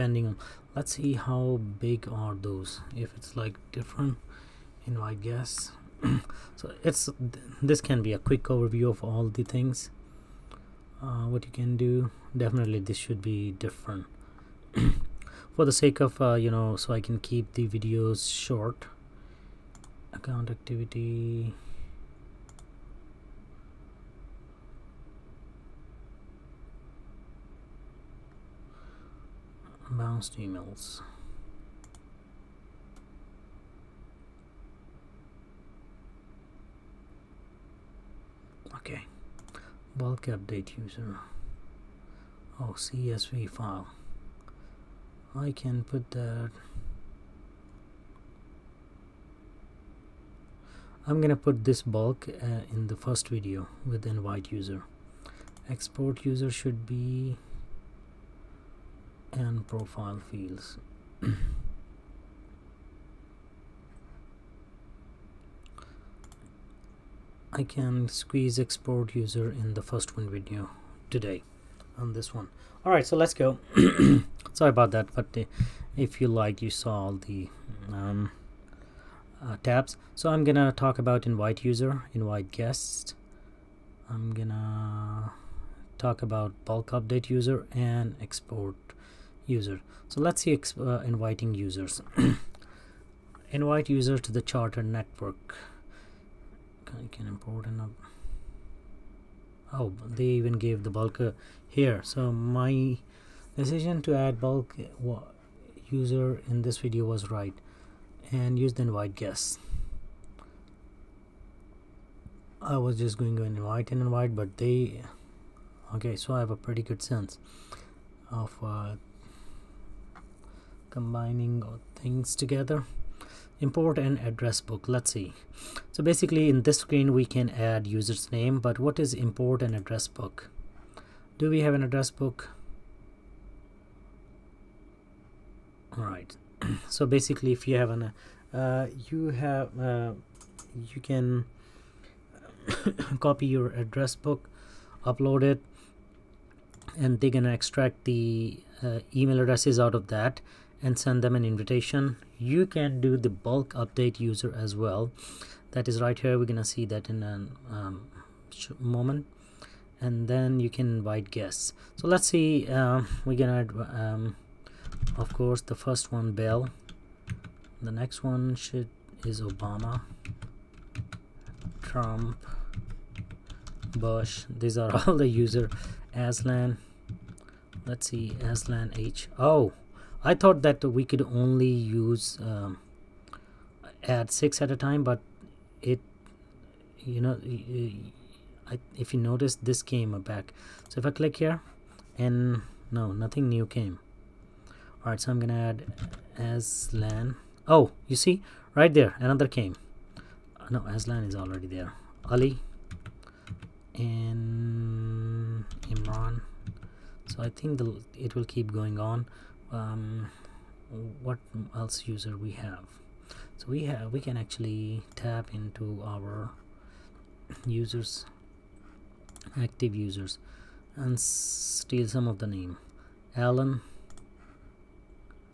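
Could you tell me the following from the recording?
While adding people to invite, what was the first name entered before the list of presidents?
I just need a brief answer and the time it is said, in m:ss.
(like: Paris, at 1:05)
Bell, at 2:46.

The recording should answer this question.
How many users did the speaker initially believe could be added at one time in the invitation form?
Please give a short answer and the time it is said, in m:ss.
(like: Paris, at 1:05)
6, at 3:04.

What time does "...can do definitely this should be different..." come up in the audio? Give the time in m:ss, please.
0:11.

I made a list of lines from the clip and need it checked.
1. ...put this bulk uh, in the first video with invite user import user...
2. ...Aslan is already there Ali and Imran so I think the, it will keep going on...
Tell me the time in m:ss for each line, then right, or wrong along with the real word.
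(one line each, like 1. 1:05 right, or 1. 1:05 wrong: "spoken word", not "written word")
1. 0:51 wrong: "export", not "import"
2. 3:20 right.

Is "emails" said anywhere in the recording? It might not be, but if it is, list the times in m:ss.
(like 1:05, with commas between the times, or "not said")
0:30, 2:29.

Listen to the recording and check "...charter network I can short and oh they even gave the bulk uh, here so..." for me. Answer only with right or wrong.
wrong.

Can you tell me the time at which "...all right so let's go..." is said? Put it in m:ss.
1:12.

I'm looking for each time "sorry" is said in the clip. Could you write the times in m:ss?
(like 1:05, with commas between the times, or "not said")
1:14.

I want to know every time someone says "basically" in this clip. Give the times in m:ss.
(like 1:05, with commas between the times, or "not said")
2:06, 2:17.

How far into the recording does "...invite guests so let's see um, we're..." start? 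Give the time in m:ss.
2:40.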